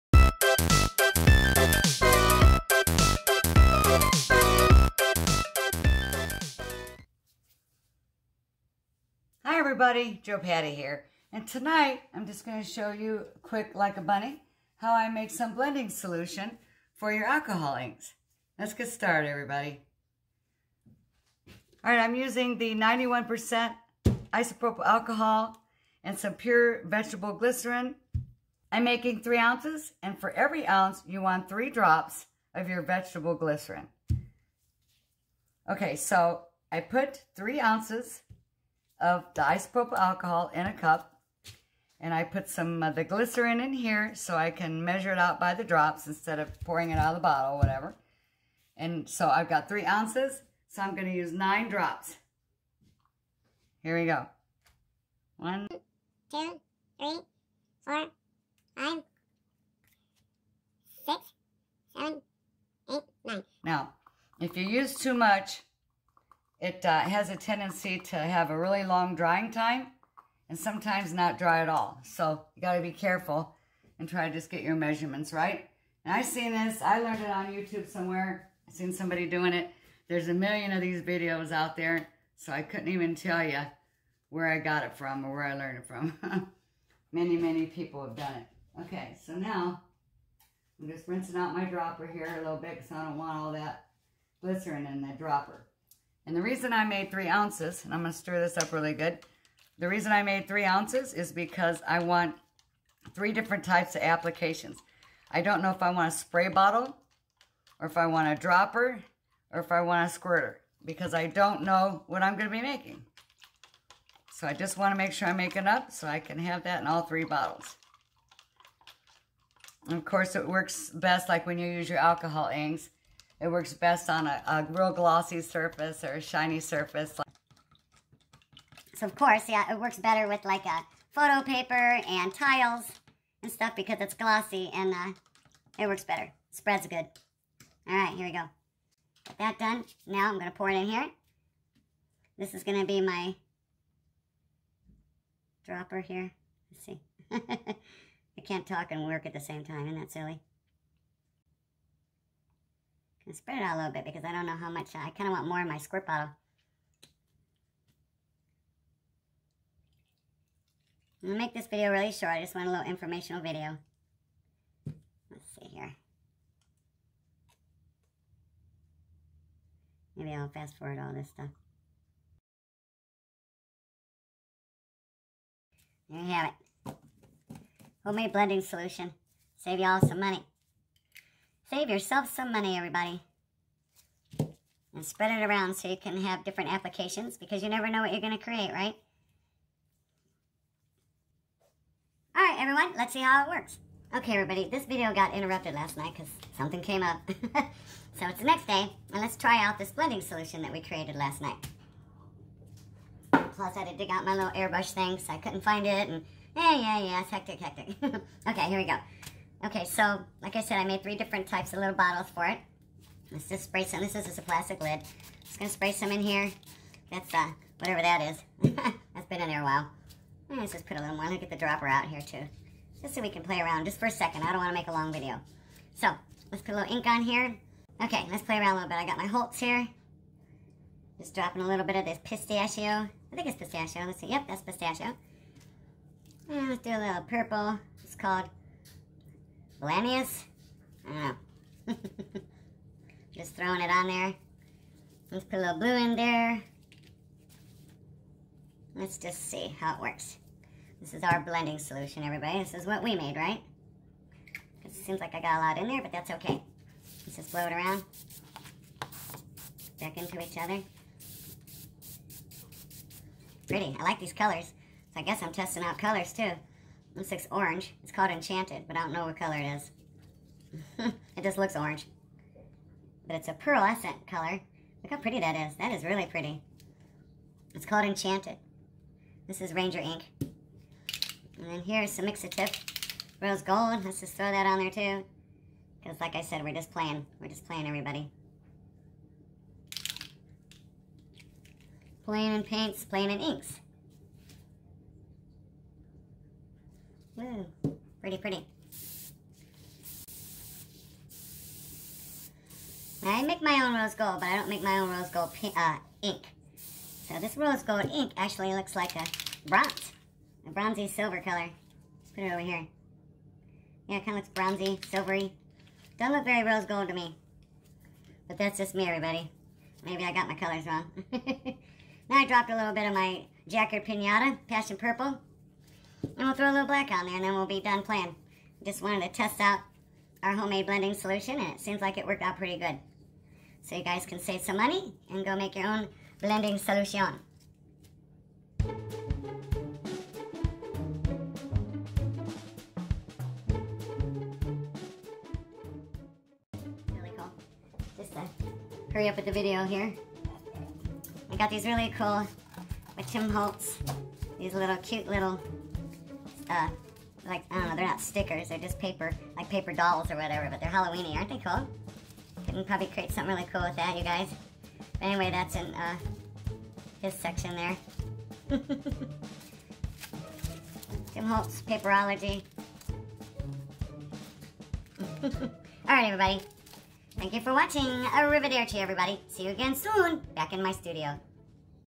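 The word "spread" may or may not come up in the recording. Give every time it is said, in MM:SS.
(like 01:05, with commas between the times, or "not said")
02:16, 02:33, 03:05.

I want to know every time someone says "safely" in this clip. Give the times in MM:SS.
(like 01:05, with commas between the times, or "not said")
not said.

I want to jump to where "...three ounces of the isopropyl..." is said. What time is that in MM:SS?
00:37.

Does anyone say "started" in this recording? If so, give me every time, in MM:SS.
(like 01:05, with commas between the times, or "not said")
00:18.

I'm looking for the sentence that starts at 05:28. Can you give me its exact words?
Just wanted to test out our homemade blending solution and it seems like it worked out pretty good.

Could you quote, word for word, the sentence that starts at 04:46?
Because like I said, we're just playing.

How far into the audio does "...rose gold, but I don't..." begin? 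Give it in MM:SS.
05:03.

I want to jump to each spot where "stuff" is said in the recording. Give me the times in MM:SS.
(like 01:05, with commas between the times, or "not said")
02:13, 02:51.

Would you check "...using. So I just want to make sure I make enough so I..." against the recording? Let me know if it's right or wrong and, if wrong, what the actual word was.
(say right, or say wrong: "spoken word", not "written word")
wrong: "making", not "using".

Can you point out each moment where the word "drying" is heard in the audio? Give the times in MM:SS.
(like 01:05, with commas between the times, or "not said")
01:09.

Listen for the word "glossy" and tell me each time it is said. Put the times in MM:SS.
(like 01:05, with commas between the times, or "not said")
02:04, 02:14.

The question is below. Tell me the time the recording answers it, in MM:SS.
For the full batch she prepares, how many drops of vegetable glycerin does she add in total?
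00:51.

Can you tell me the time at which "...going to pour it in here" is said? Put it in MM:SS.
02:20.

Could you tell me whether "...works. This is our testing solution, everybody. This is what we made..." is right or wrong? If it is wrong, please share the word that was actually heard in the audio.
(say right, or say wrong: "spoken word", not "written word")
wrong: "blending", not "testing".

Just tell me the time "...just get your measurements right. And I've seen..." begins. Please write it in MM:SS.
01:14.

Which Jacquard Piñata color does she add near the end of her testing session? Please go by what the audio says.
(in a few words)
Passion Purple.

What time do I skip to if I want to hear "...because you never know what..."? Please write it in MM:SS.
03:07.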